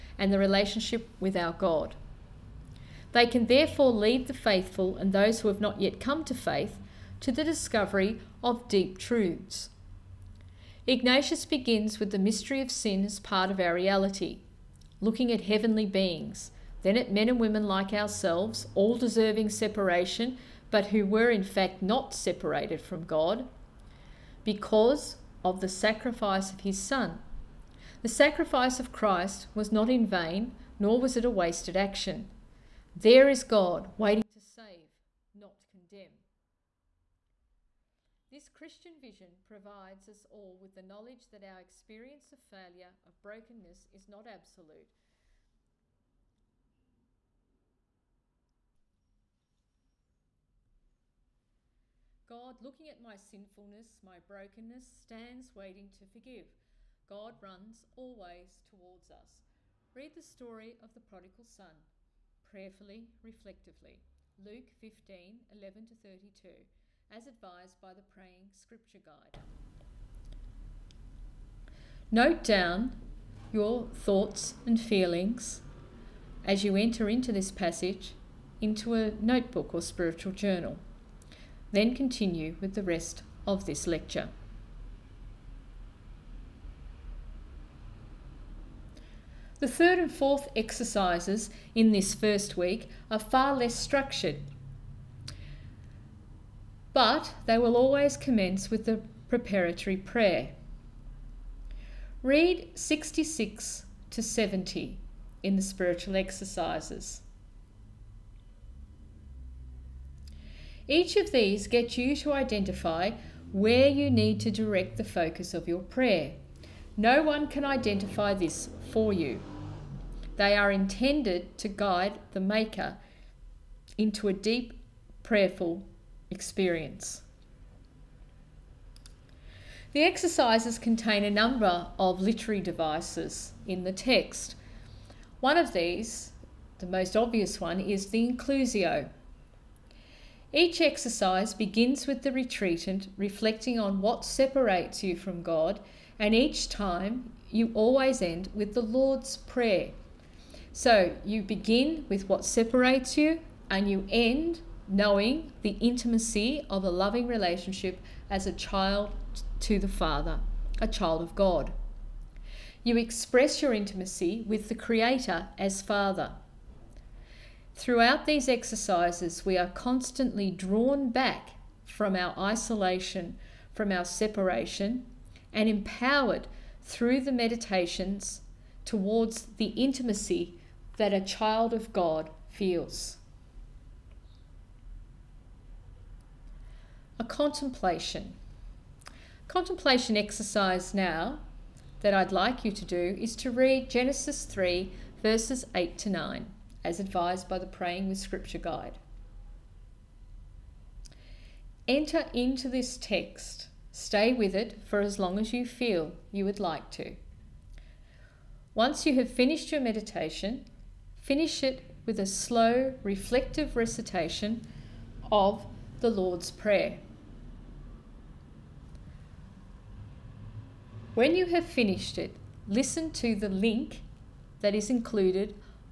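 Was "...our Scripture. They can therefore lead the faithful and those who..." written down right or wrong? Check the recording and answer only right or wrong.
wrong.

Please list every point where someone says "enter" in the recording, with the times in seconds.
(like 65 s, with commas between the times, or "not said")
76 s, 201 s.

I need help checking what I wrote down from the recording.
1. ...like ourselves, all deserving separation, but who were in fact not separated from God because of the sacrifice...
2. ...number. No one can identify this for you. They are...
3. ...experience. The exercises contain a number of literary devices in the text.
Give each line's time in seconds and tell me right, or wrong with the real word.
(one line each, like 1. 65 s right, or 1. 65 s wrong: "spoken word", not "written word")
1. 17 s right
2. 115 s wrong: "prayer", not "number"
3. 126 s right.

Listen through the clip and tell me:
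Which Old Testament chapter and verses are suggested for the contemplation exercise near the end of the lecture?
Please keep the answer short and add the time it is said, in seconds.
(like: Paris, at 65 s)
Genesis 3:8-9, at 193 s.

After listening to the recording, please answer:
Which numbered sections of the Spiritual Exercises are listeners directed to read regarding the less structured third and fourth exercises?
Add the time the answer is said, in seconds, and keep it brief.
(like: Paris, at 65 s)
66 to 70, at 102 s.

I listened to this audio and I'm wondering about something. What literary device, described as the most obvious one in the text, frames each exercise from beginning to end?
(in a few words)
inclusio.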